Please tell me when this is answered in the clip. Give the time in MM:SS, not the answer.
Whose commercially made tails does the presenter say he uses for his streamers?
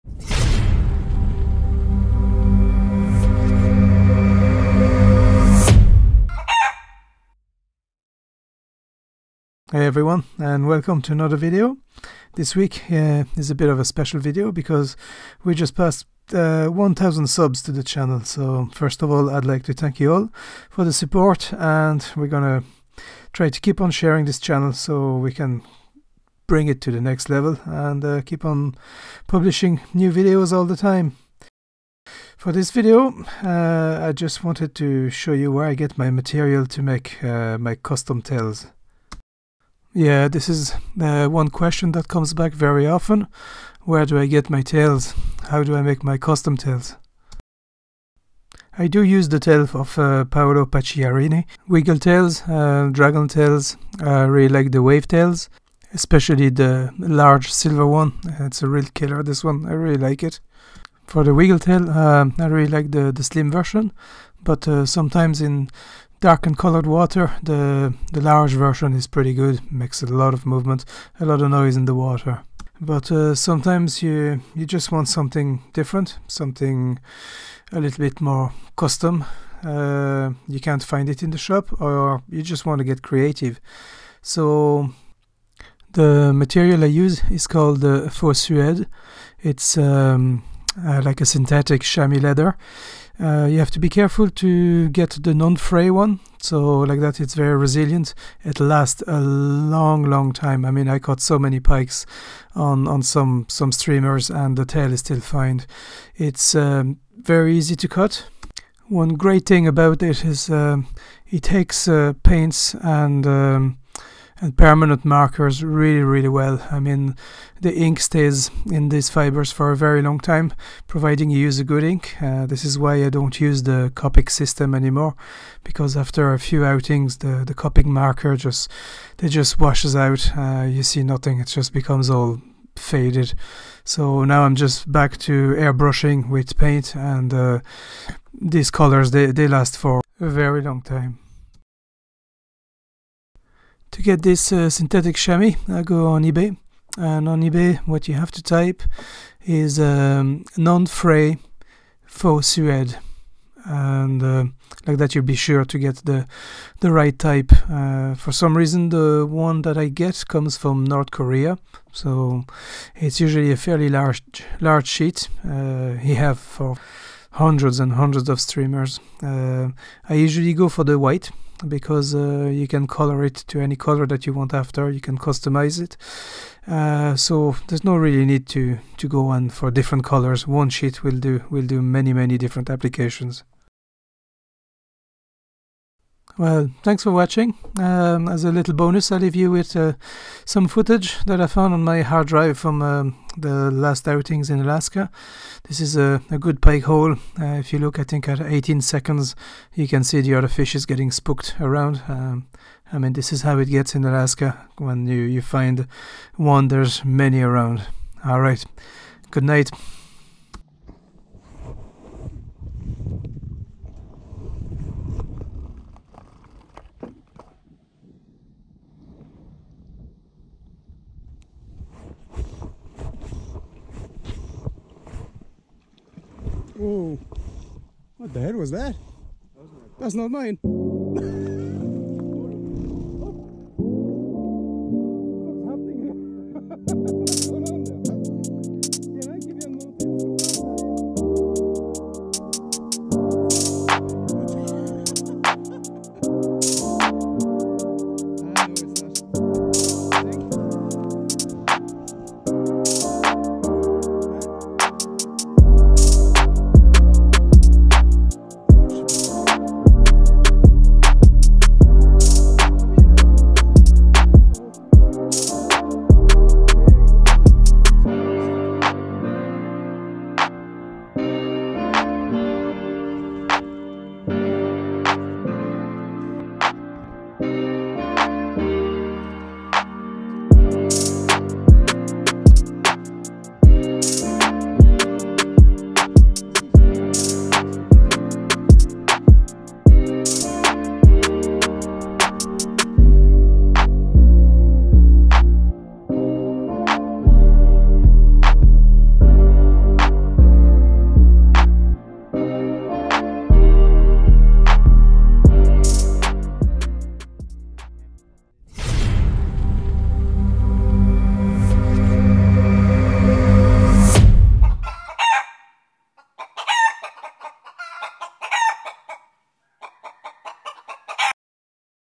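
00:50.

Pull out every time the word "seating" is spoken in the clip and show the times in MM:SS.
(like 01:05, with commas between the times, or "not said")
not said.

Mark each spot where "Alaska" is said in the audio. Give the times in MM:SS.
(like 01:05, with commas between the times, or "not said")
03:14, 03:24.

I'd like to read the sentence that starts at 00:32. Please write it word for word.
For this video, uh, I just wanted to show you where I get my material to make uh, my custom tails.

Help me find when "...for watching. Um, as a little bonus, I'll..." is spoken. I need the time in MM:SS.
03:07.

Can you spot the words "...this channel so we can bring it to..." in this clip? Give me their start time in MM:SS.
00:24.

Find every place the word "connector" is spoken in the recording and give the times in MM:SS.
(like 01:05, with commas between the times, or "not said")
not said.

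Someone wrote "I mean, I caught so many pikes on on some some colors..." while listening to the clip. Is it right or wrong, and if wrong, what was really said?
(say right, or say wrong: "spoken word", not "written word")
wrong: "streamers", not "colors".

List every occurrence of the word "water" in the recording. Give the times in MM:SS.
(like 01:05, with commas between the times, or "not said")
01:06, 01:11.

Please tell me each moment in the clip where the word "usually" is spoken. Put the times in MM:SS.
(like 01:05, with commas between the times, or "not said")
02:43, 02:50.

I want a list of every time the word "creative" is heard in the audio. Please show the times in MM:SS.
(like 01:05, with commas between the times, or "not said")
01:23.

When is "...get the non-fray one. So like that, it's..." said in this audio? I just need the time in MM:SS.
01:34.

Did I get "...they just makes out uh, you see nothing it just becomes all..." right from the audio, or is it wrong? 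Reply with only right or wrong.
wrong.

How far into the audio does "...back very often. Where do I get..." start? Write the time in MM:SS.
00:42.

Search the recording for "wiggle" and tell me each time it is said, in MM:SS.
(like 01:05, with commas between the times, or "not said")
00:51, 01:01.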